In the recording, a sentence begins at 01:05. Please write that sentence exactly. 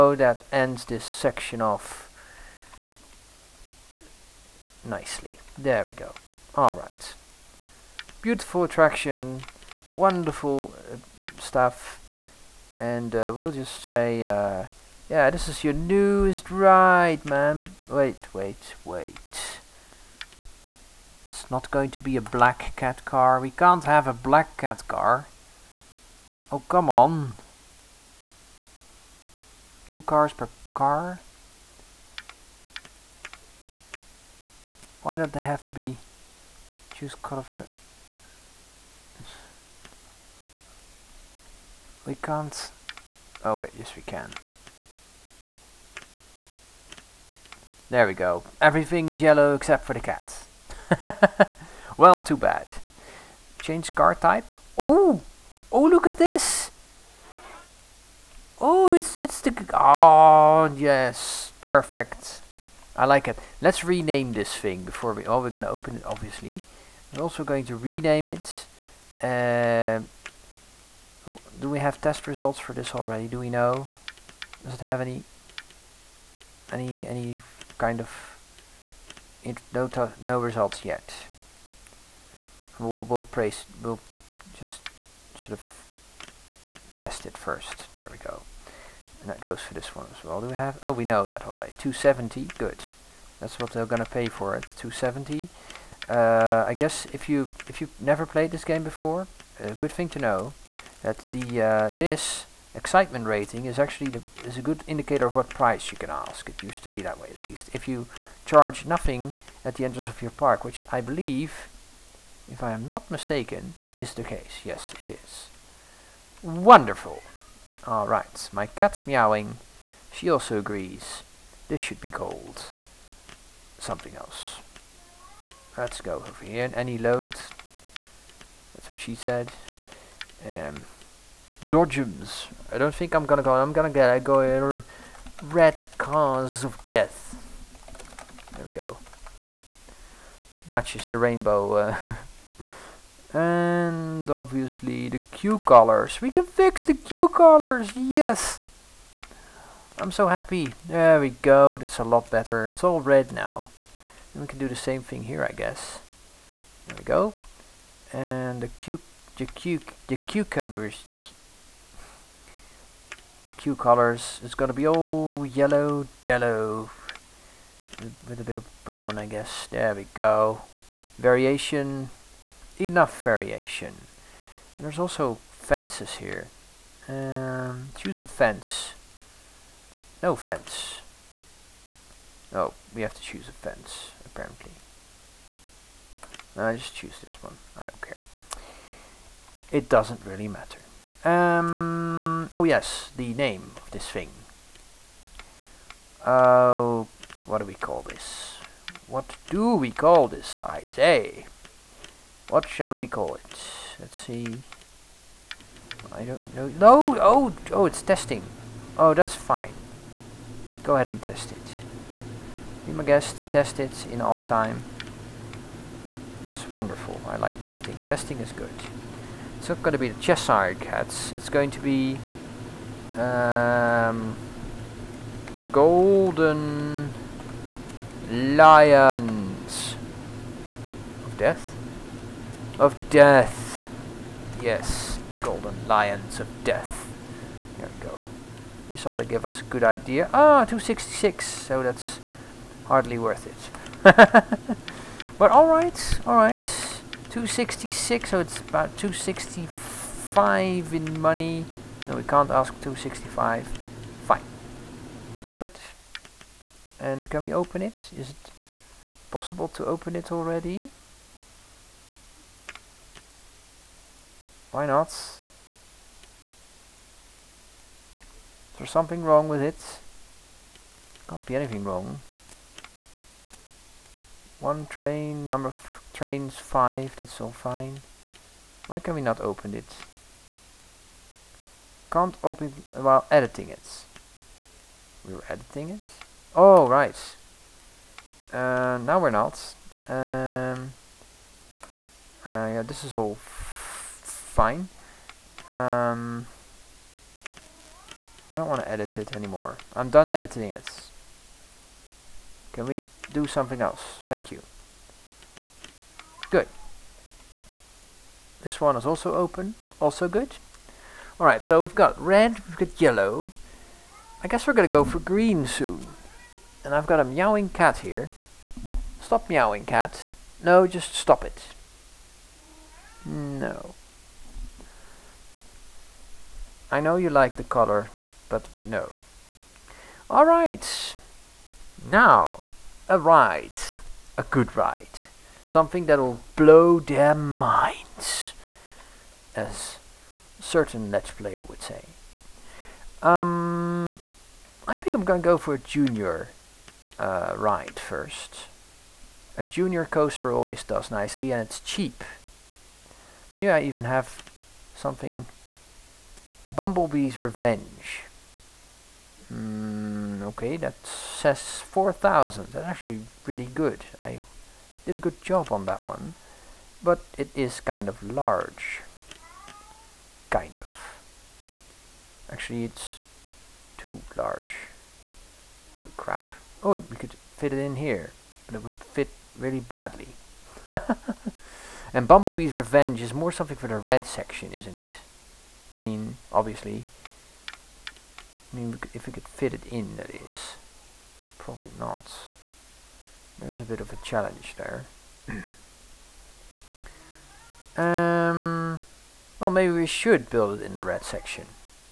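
Oh, we're going to open it, obviously.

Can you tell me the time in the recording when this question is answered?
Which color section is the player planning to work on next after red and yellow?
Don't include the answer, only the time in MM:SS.
05:15.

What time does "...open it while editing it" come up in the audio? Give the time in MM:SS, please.
04:42.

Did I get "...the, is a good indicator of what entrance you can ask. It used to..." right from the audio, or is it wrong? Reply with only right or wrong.
wrong.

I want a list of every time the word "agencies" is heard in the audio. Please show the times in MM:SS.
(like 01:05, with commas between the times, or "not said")
not said.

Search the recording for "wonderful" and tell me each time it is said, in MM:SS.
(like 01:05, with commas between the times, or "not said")
00:09, 01:56, 03:36.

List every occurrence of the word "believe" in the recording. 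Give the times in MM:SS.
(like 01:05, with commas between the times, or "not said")
01:50.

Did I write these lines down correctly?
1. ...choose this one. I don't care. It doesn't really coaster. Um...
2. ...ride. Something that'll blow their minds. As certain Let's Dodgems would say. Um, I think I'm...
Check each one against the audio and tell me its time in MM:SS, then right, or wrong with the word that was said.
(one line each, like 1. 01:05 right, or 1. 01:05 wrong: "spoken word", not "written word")
1. 03:06 wrong: "matter", not "coaster"
2. 05:34 wrong: "Player", not "Dodgems".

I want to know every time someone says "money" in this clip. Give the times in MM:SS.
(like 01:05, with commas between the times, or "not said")
04:11.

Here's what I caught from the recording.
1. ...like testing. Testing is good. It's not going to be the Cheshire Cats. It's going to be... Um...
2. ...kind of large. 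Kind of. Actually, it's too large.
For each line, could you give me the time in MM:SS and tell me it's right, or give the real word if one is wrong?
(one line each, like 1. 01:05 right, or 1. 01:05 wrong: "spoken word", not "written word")
1. 03:37 right
2. 06:07 right.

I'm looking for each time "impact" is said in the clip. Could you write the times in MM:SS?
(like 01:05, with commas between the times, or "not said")
not said.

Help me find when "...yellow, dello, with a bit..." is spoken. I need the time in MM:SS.
02:45.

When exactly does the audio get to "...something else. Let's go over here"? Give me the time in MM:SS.
02:03.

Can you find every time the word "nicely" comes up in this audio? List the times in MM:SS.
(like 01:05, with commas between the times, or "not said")
00:04, 05:51.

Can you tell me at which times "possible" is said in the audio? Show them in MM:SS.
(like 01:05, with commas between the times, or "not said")
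04:19.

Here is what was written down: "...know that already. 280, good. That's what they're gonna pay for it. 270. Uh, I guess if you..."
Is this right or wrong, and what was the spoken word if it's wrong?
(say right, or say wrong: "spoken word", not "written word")
wrong: "270", not "280".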